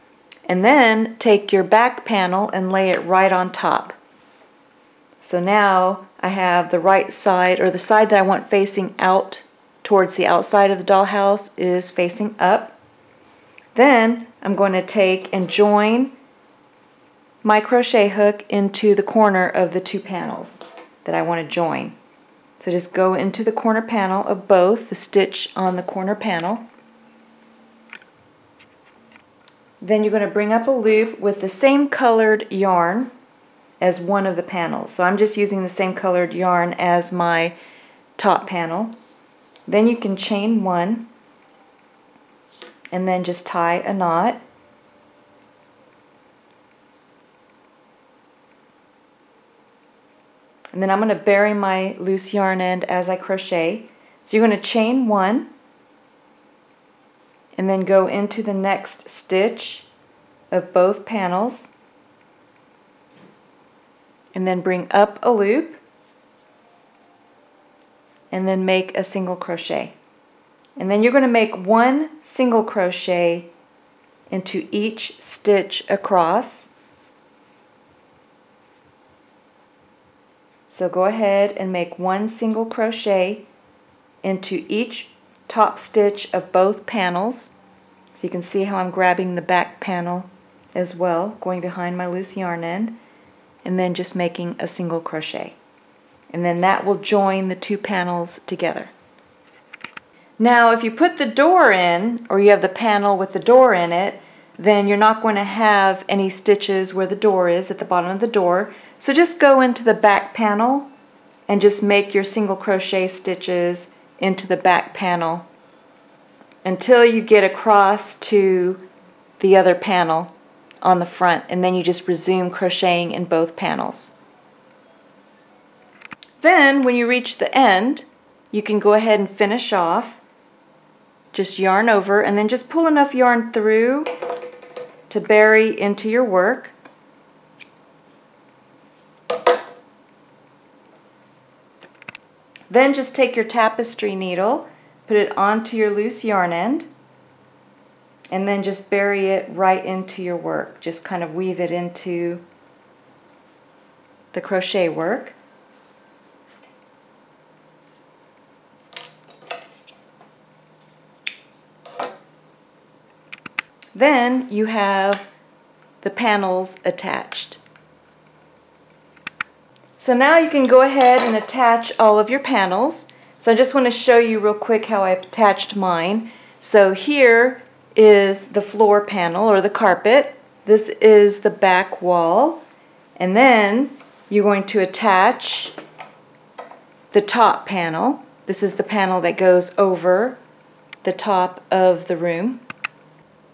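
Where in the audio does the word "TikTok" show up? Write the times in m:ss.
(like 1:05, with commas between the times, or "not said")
not said.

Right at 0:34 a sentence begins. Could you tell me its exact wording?
So I'm just using the same colored yarn as my top panel.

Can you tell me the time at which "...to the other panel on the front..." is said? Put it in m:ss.
1:58.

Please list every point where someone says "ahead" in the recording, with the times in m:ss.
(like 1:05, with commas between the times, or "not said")
1:21, 2:08, 2:50.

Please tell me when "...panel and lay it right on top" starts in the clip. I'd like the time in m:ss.
0:02.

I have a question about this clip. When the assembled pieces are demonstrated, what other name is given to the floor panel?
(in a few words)
The carpet.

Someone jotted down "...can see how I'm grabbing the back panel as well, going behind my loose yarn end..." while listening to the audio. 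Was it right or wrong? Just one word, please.
right.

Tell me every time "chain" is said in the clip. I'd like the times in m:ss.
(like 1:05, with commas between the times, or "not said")
0:40, 0:54.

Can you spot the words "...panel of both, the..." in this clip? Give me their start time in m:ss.
0:23.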